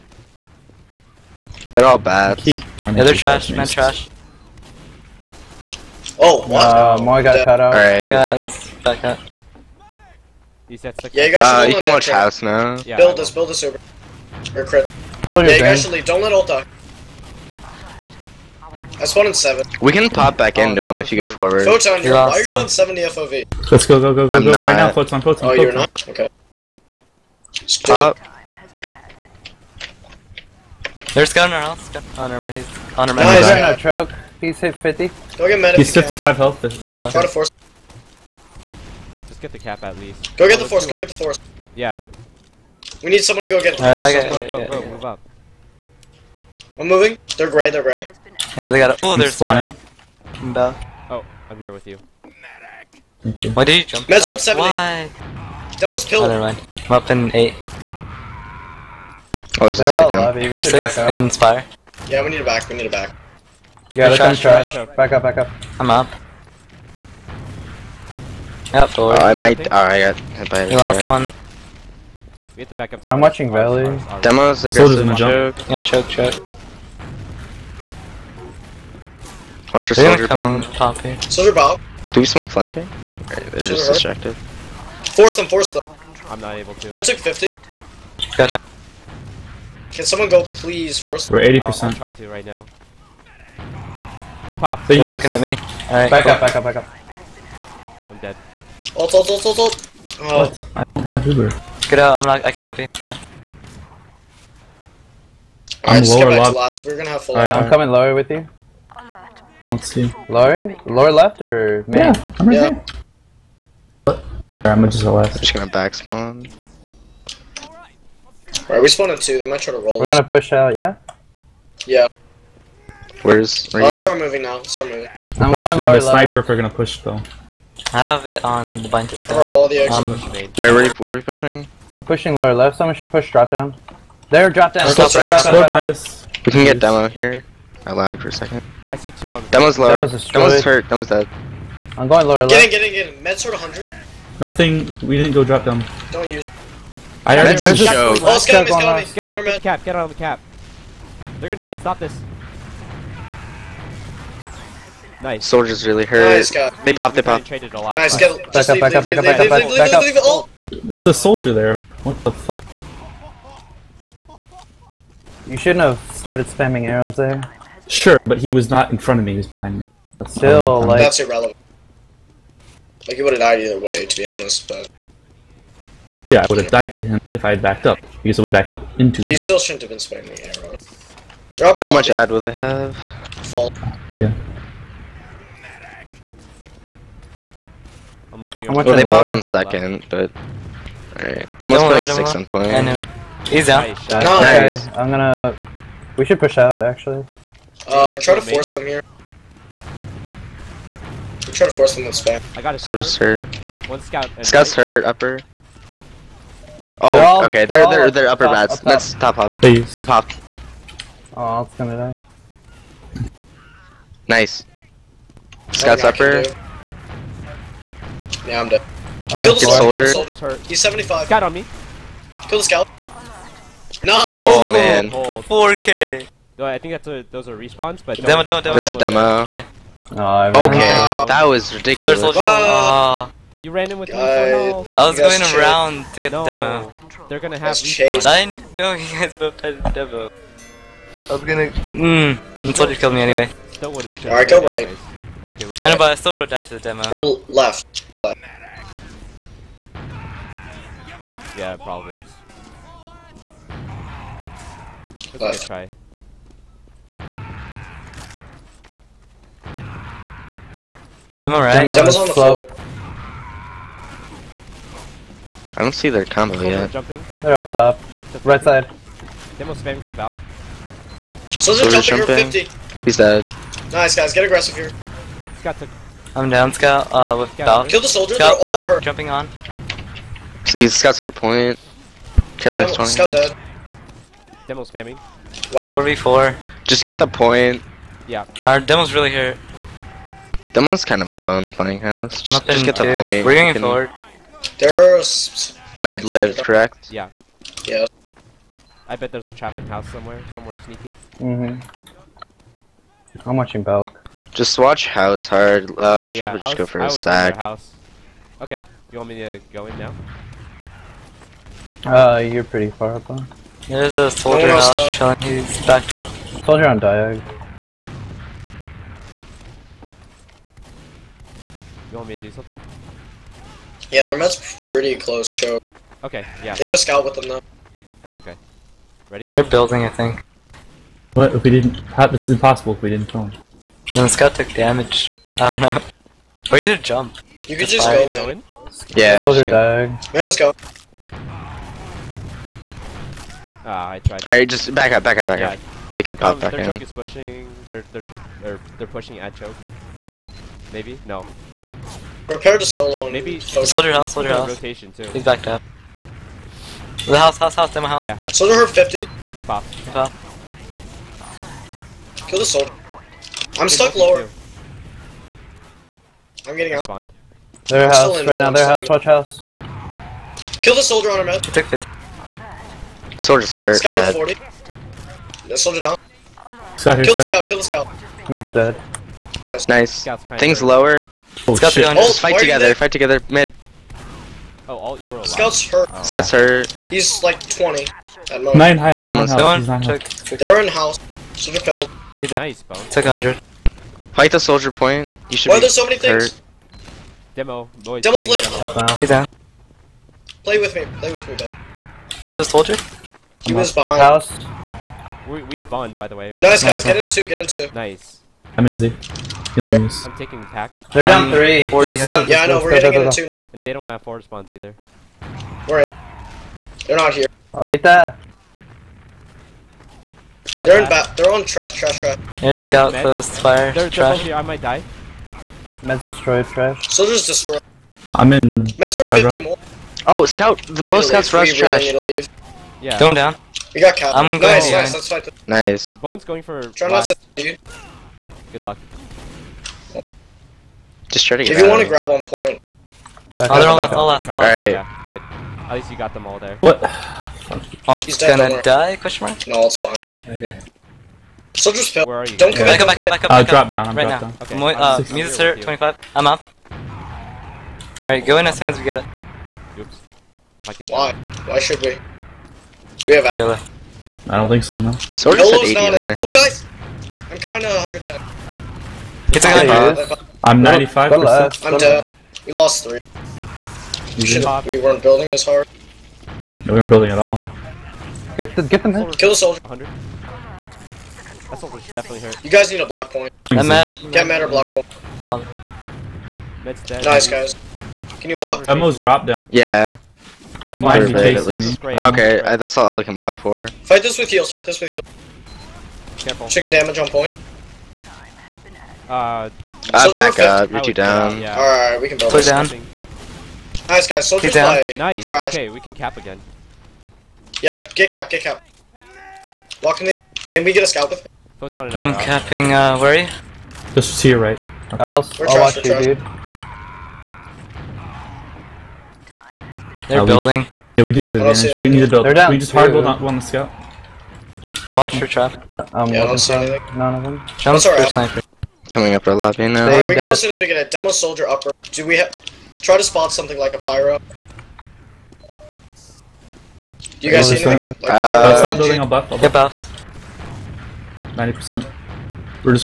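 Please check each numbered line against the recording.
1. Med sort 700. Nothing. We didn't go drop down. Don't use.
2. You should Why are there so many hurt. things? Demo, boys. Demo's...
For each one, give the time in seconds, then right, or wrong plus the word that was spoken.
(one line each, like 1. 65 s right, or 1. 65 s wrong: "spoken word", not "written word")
1. 143 s wrong: "100", not "700"
2. 395 s right.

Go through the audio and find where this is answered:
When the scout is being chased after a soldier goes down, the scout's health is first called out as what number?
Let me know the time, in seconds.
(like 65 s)
373 s.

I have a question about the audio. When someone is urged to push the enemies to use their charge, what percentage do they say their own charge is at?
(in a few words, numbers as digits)
80%.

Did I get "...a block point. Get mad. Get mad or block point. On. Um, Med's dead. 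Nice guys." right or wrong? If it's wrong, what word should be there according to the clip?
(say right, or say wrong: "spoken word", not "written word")
right.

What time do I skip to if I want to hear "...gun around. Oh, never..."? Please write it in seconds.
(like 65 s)
31 s.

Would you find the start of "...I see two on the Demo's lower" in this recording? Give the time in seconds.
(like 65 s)
138 s.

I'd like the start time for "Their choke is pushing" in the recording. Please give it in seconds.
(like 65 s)
346 s.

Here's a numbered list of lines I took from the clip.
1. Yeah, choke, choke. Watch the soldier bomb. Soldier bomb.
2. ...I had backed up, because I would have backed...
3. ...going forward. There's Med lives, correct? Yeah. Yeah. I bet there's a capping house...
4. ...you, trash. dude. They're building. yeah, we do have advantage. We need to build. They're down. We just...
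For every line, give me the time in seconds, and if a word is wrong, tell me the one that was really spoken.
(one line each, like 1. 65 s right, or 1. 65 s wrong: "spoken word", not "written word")
1. 75 s right
2. 177 s right
3. 293 s wrong: "trapping", not "capping"
4. 515 s right.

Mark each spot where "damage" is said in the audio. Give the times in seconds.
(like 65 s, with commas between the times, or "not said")
334 s, 496 s.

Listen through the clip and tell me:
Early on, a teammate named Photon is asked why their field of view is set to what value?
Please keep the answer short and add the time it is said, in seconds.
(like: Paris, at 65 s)
70, at 22 s.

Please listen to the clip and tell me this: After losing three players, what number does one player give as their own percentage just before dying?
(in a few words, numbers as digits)
95%.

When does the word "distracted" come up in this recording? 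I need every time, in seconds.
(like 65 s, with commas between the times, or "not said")
83 s.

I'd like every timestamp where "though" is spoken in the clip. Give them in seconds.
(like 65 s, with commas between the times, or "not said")
127 s, 327 s.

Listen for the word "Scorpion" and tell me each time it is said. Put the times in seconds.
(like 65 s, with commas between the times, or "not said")
381 s.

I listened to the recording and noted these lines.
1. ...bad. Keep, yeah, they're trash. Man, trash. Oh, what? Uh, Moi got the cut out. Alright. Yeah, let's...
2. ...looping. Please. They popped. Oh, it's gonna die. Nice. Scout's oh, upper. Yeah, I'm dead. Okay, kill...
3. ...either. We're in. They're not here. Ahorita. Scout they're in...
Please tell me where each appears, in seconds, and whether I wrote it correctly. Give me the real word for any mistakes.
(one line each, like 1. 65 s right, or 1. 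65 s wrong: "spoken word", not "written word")
1. 1 s right
2. 209 s wrong: "hopping", not "looping"
3. 414 s right.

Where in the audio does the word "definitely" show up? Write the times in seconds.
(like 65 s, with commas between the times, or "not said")
482 s.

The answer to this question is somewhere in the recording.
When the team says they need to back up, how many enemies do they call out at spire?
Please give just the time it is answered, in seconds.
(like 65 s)
60 s.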